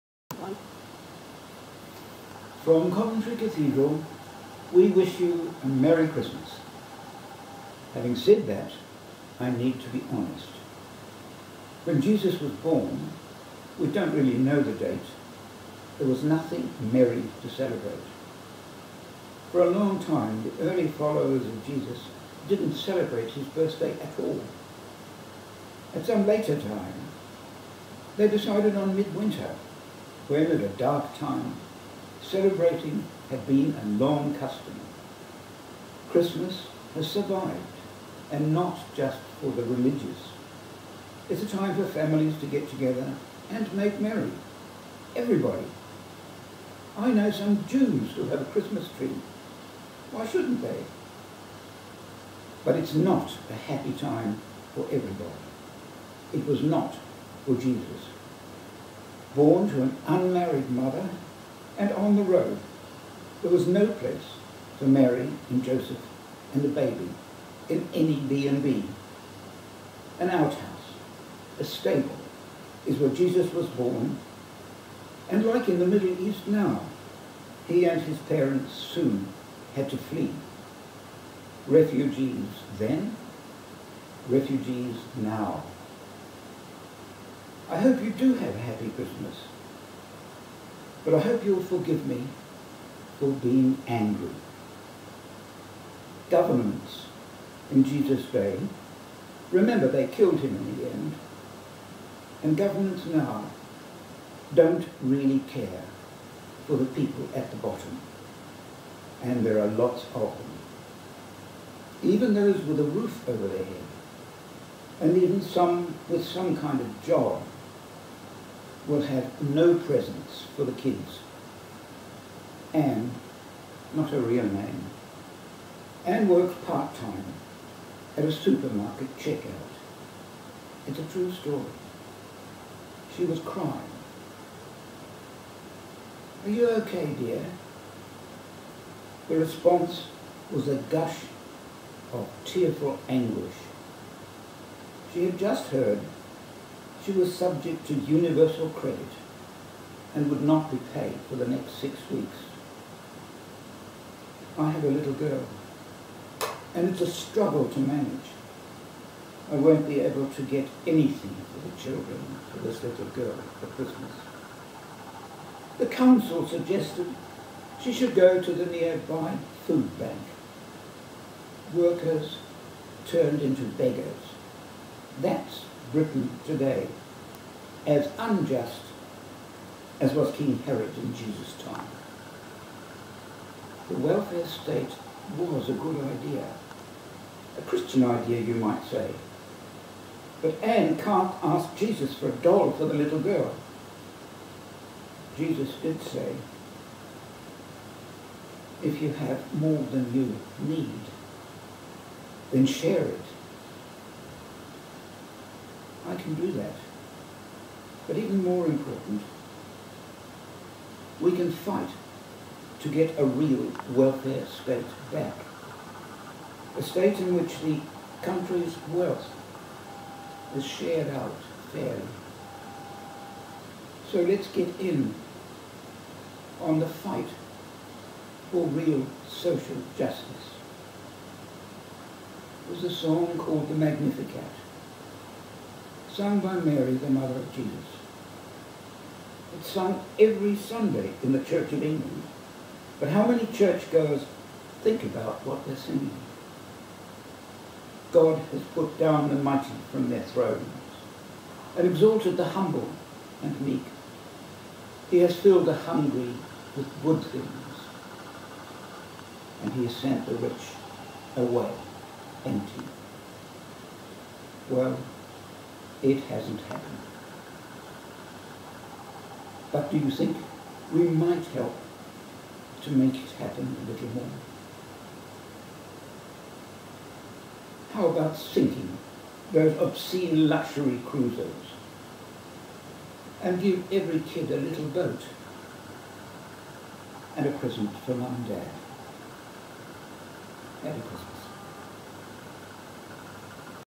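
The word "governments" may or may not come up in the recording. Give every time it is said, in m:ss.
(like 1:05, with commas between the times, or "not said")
1:36, 1:42.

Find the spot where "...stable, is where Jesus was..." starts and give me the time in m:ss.
1:11.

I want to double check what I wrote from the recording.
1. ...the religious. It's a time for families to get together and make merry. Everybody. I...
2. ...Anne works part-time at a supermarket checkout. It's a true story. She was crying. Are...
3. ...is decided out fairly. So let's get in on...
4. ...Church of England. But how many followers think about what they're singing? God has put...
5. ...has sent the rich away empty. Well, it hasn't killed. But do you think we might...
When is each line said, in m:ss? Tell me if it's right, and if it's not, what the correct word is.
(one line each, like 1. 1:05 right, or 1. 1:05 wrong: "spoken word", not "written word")
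1. 0:39 right
2. 2:06 right
3. 3:40 wrong: "shared", not "decided"
4. 4:01 wrong: "churchgoers", not "followers"
5. 4:19 wrong: "happened", not "killed".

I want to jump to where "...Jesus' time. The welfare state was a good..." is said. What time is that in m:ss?
3:01.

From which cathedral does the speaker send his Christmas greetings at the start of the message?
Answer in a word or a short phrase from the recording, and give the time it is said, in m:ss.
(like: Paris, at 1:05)
Coventry Cathedral, at 0:02.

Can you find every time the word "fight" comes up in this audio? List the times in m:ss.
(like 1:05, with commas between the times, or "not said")
3:31, 3:46.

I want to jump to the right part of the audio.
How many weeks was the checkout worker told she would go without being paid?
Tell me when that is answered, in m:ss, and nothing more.
2:31.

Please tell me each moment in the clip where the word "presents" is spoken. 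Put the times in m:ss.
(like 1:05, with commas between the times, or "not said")
1:59, 4:47.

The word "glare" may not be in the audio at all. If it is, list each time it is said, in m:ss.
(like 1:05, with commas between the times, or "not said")
not said.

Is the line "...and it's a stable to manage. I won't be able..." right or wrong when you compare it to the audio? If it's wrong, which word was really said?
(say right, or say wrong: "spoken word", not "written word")
wrong: "struggle", not "stable".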